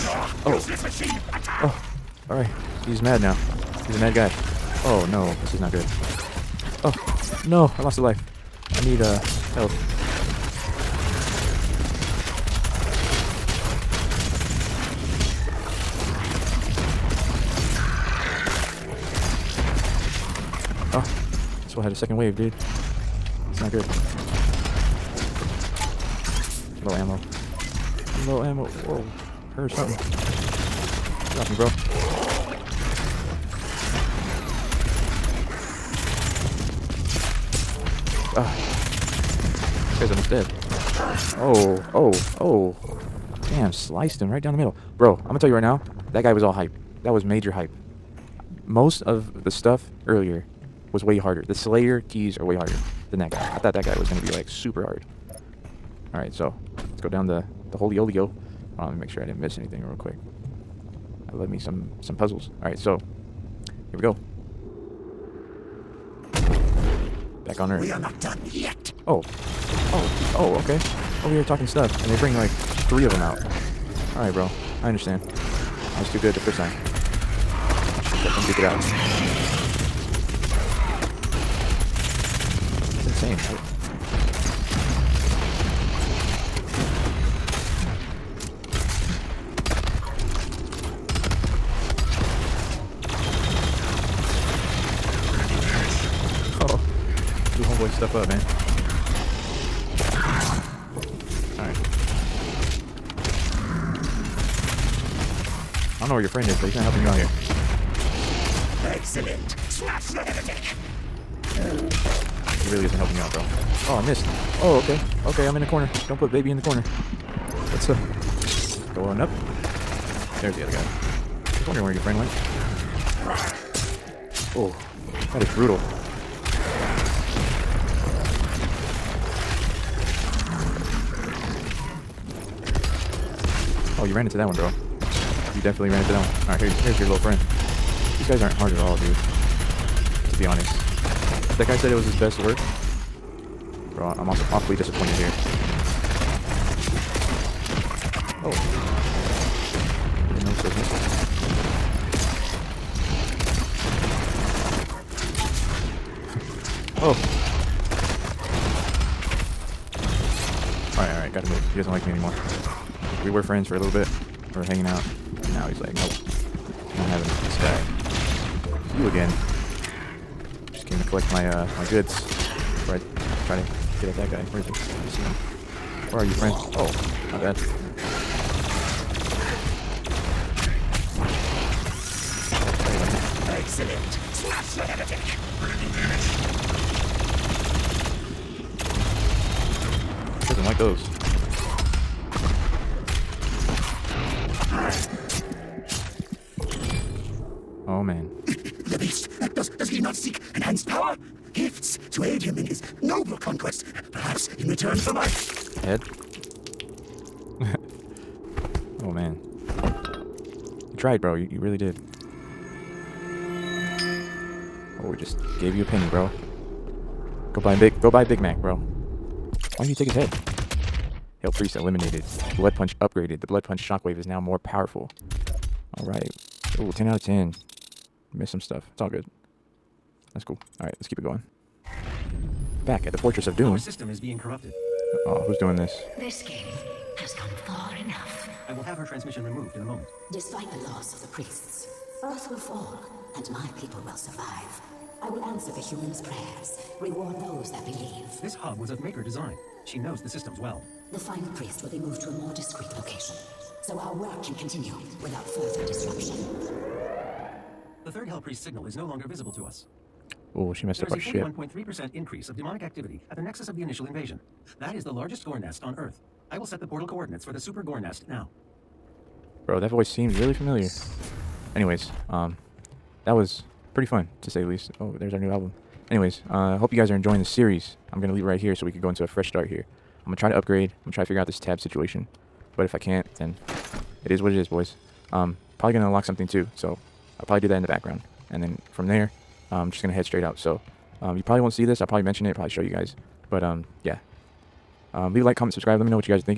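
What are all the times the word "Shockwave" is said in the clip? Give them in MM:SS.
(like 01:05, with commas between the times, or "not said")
03:43.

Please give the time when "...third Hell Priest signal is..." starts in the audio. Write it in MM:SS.
04:18.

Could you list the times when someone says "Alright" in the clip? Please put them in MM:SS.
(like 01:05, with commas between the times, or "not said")
00:56, 01:14, 02:16, 03:45, 03:50.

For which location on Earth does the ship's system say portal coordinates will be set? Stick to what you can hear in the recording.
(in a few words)
super gore nest.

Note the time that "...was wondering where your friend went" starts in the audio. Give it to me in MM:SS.
02:01.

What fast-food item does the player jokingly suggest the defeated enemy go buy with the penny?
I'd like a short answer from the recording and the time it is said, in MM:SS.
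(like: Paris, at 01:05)
Big Mac, at 03:38.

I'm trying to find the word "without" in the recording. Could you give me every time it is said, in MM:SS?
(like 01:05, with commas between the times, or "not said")
04:15.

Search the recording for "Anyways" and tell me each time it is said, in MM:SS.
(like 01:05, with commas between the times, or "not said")
04:31, 04:36.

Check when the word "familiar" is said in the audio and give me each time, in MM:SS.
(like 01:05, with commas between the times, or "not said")
04:30.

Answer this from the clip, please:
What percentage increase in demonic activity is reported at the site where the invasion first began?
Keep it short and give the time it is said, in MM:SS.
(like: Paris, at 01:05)
41.3%, at 04:22.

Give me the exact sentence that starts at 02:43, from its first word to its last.
We were friends for a little bit.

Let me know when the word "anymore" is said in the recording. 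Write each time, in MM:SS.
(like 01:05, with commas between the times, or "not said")
02:42.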